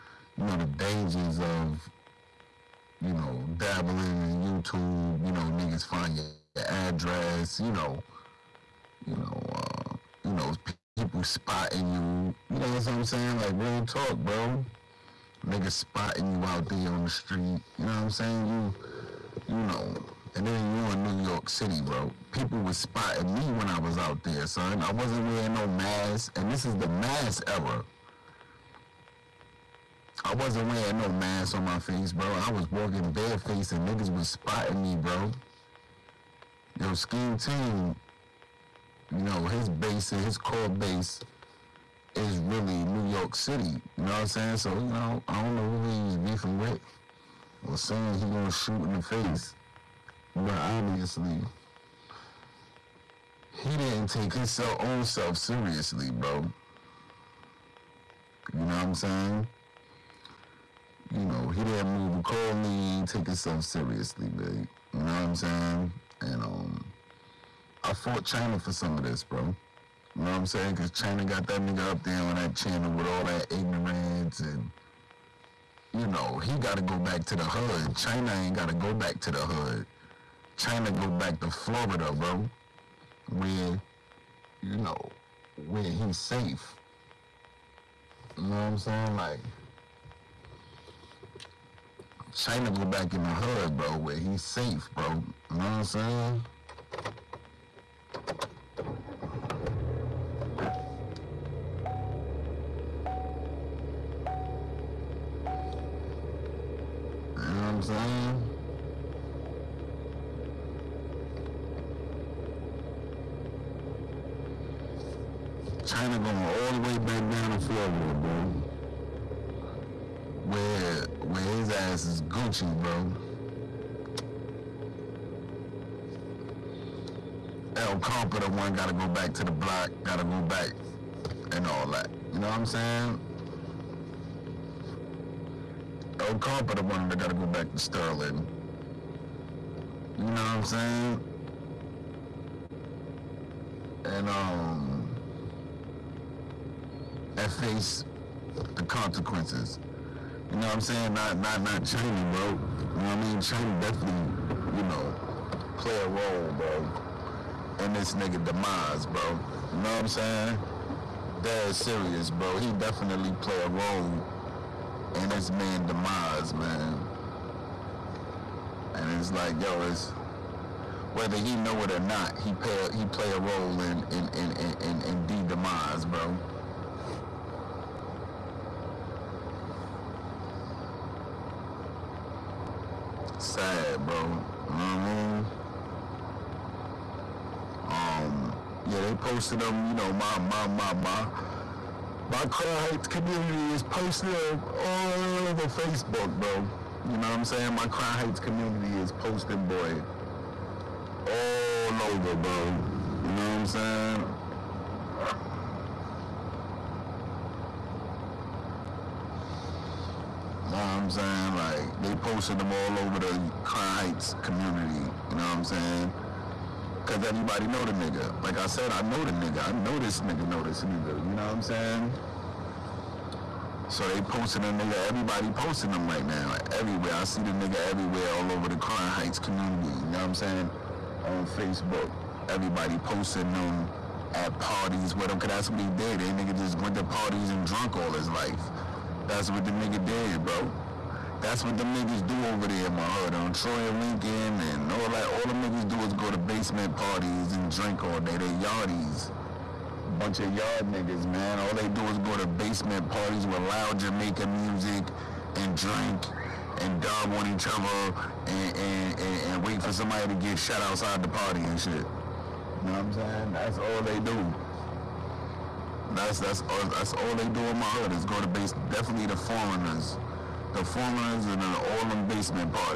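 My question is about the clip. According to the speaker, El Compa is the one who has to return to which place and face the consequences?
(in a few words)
Sterling.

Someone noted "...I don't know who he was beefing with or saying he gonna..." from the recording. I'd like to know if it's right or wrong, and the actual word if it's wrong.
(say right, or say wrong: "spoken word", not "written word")
right.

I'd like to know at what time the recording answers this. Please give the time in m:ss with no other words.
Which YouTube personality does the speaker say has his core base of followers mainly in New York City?
0:36.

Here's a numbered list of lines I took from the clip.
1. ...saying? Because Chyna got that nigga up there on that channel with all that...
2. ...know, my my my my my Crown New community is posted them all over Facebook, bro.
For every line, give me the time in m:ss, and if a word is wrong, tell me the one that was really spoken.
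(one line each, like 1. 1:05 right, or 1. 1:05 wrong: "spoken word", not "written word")
1. 1:10 right
2. 3:09 wrong: "Heights", not "New".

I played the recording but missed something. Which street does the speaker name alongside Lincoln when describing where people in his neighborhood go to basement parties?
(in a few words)
Troy.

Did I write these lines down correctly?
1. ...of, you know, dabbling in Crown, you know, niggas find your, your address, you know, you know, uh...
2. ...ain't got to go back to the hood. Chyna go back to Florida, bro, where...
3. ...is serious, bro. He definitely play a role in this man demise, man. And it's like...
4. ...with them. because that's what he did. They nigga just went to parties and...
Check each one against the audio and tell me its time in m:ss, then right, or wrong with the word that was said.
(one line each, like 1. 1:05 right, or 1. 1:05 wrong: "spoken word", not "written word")
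1. 0:01 wrong: "YouTube", not "Crown"
2. 1:18 right
3. 2:41 right
4. 3:55 right.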